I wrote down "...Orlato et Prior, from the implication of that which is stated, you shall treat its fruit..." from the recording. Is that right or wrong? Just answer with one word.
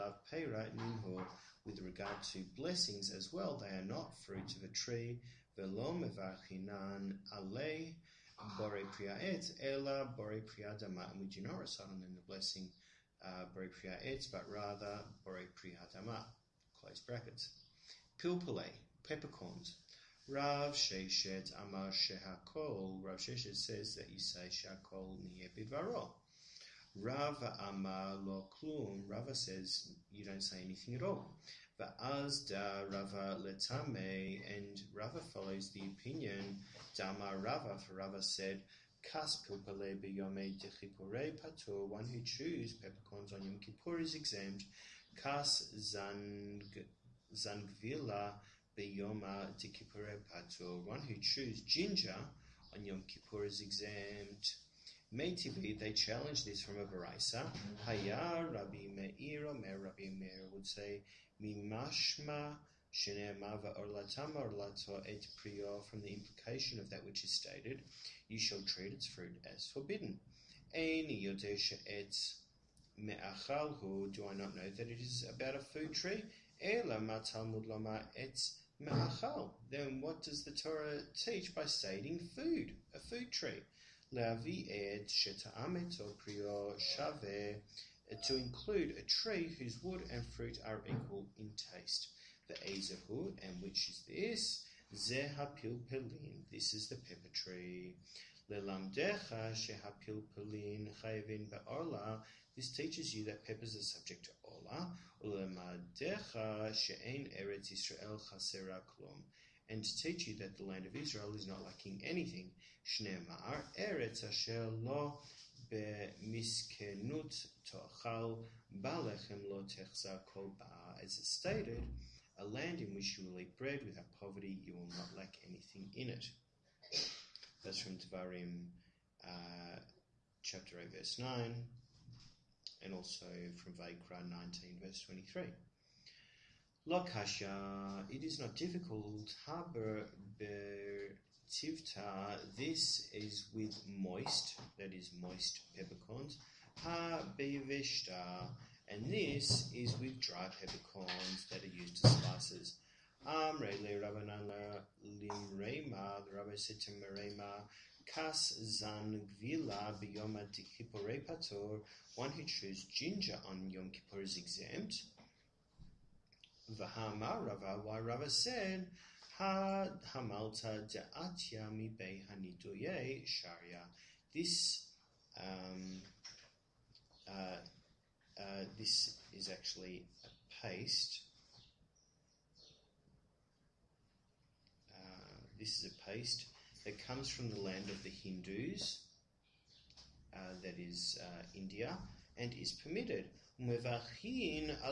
right.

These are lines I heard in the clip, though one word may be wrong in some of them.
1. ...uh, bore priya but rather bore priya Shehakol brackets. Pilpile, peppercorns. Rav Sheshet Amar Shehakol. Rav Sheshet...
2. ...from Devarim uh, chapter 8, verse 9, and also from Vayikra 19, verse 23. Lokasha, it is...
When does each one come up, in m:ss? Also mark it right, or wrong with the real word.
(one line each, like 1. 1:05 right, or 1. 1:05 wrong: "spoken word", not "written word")
1. 0:13 wrong: "Close", not "Shehakol"
2. 2:07 right.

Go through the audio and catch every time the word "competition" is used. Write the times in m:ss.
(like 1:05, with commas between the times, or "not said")
not said.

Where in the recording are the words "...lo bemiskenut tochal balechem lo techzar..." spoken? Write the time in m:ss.
1:54.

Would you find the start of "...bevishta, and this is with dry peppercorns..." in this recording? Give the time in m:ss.
2:27.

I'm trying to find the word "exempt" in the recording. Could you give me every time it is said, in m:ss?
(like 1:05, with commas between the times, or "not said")
0:44, 0:53, 2:44.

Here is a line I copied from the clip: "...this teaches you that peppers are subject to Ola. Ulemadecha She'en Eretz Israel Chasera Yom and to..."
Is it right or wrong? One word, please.
wrong.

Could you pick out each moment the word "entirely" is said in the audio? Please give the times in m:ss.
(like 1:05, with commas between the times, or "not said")
not said.